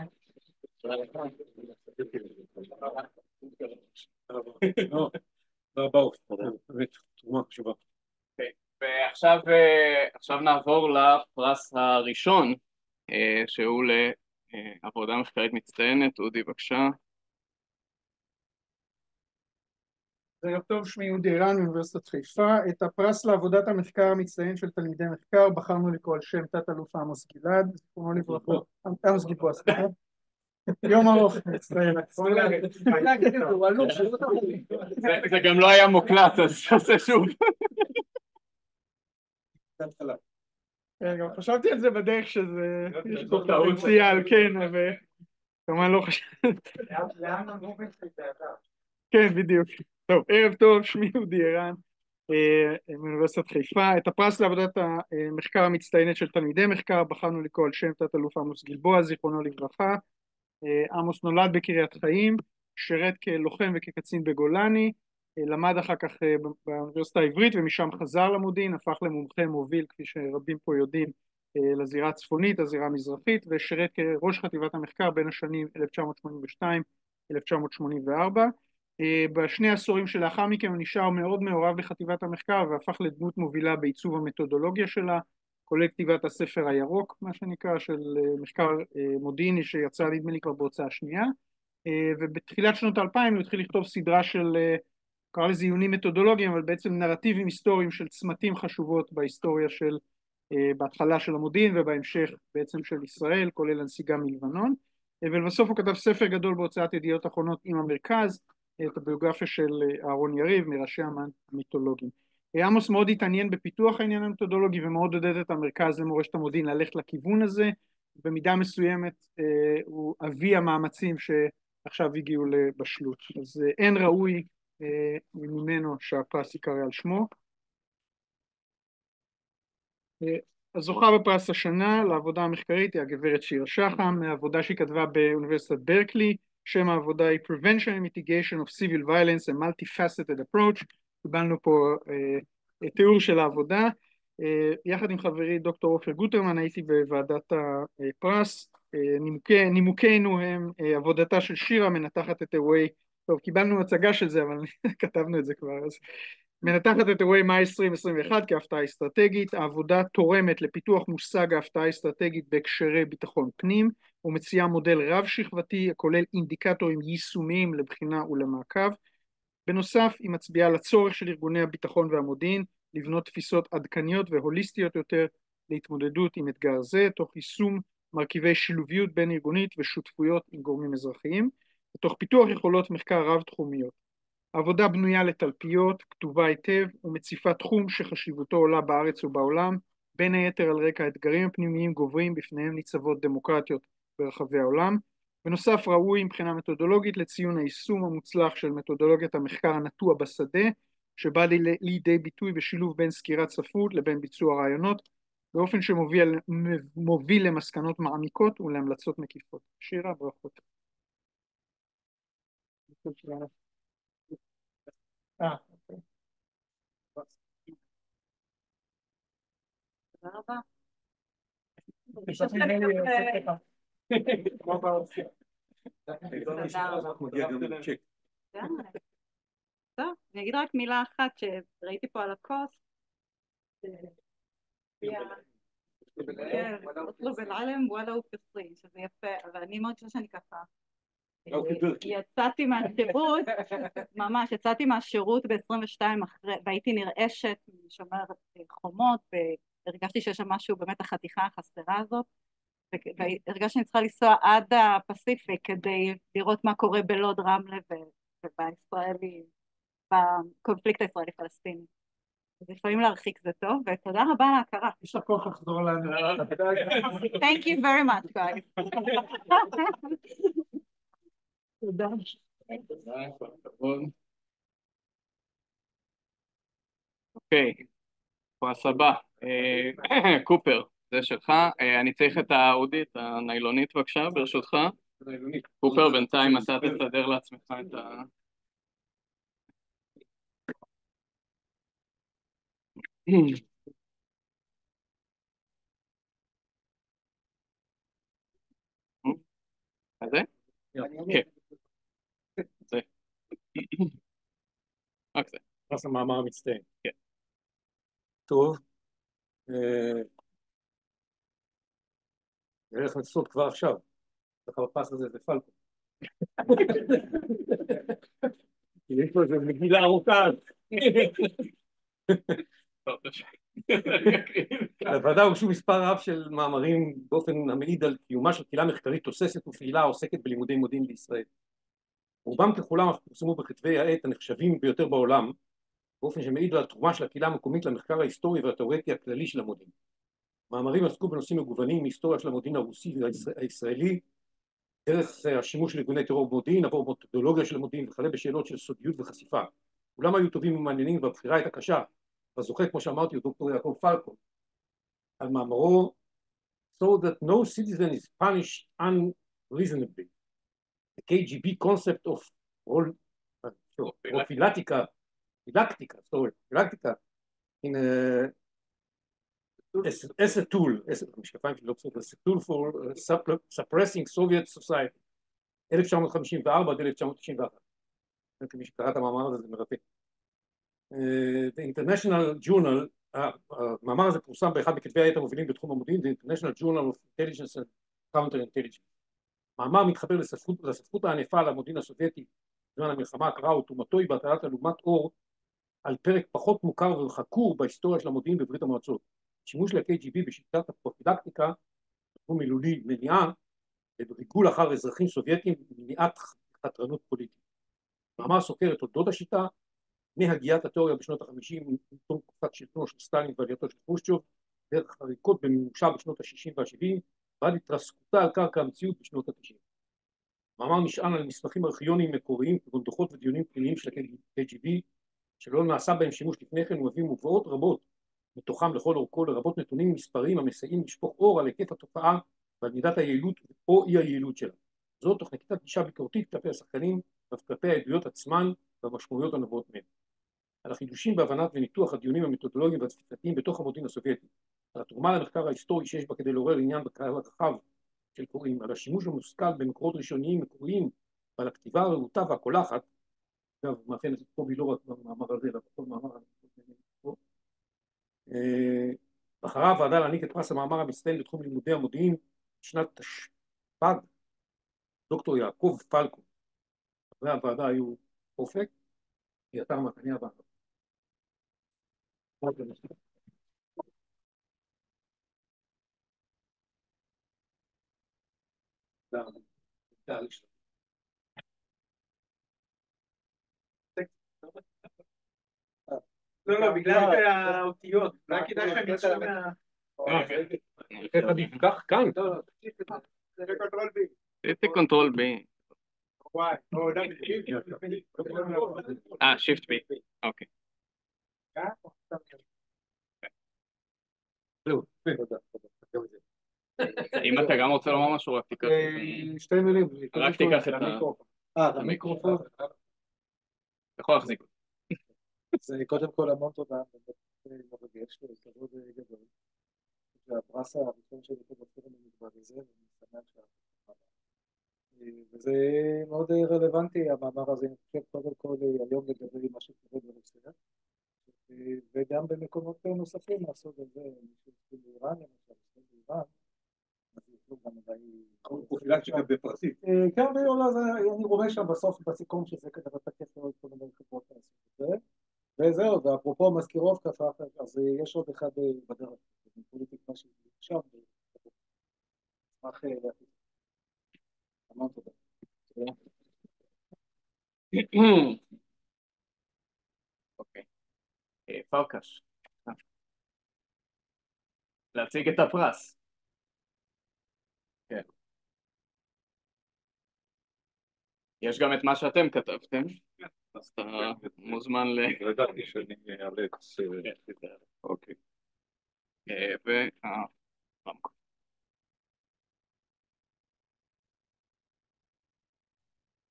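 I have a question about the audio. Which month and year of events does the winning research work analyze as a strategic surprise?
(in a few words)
May 2021.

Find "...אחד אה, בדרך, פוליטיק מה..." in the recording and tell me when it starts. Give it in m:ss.
9:08.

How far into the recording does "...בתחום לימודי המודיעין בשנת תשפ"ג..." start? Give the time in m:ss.
7:41.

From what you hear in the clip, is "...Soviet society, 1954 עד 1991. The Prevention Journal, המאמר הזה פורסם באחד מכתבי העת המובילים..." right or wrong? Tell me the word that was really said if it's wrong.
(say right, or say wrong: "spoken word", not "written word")
wrong: "International", not "Prevention".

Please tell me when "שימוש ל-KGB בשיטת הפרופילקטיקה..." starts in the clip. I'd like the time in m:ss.
6:39.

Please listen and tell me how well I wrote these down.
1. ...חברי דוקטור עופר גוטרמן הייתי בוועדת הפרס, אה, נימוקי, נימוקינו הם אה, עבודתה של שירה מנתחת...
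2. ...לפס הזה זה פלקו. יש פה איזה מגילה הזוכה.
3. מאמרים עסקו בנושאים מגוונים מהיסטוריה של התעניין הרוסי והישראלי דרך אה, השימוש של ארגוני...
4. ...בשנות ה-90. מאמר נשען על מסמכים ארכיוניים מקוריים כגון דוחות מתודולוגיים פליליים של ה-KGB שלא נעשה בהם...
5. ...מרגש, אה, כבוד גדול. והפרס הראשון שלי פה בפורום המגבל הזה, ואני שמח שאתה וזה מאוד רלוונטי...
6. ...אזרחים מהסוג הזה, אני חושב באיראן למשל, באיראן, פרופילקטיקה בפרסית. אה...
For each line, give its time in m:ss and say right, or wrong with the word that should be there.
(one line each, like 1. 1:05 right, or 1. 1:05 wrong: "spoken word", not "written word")
1. 2:25 right
2. 5:14 wrong: "ארוכה", not "הזוכה"
3. 5:40 wrong: "המודיעין", not "התעניין"
4. 6:59 wrong: "ודיונים", not "מתודולוגיים"
5. 8:37 right
6. 8:53 wrong: "נוספים", not "אזרחים".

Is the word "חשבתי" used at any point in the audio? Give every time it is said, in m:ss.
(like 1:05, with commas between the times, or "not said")
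0:41, 0:46.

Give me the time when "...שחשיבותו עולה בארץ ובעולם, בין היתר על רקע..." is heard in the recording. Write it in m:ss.
3:07.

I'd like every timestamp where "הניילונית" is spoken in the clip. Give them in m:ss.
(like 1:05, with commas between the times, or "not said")
4:43.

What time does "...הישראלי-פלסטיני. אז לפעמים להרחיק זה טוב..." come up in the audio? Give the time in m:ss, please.
4:21.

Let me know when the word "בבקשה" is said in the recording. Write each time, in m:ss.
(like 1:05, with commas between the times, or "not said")
0:16, 4:43.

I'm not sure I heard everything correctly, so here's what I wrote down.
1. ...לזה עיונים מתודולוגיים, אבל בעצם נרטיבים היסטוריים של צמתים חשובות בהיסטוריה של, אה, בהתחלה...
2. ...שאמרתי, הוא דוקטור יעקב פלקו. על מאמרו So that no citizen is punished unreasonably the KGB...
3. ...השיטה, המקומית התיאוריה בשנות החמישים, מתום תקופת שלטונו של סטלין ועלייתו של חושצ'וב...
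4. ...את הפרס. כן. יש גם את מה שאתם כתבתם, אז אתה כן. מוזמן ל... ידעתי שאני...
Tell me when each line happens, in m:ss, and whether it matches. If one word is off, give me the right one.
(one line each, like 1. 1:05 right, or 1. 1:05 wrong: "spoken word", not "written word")
1. 1:35 right
2. 5:53 right
3. 6:49 wrong: "מהגיית", not "המקומית"
4. 9:25 right.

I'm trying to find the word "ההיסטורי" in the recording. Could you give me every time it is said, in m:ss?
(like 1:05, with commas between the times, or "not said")
5:38, 7:25.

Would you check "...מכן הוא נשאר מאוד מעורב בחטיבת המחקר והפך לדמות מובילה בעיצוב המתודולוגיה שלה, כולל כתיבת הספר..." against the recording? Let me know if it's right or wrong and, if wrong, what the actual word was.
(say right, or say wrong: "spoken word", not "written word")
right.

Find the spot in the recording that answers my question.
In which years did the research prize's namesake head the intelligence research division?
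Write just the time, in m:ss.
1:17.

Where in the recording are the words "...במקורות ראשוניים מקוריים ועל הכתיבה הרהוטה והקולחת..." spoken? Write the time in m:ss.
7:29.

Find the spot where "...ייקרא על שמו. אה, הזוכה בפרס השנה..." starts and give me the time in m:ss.
2:06.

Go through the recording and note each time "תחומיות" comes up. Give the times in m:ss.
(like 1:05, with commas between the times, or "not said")
3:03.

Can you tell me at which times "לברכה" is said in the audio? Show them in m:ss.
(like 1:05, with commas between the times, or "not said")
0:28, 0:59.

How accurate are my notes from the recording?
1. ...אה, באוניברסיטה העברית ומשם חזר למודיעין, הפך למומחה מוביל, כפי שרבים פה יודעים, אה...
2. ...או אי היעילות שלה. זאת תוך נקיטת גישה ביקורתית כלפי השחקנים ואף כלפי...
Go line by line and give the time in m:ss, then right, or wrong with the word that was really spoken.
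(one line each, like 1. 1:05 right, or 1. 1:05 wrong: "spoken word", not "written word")
1. 1:06 right
2. 7:13 right.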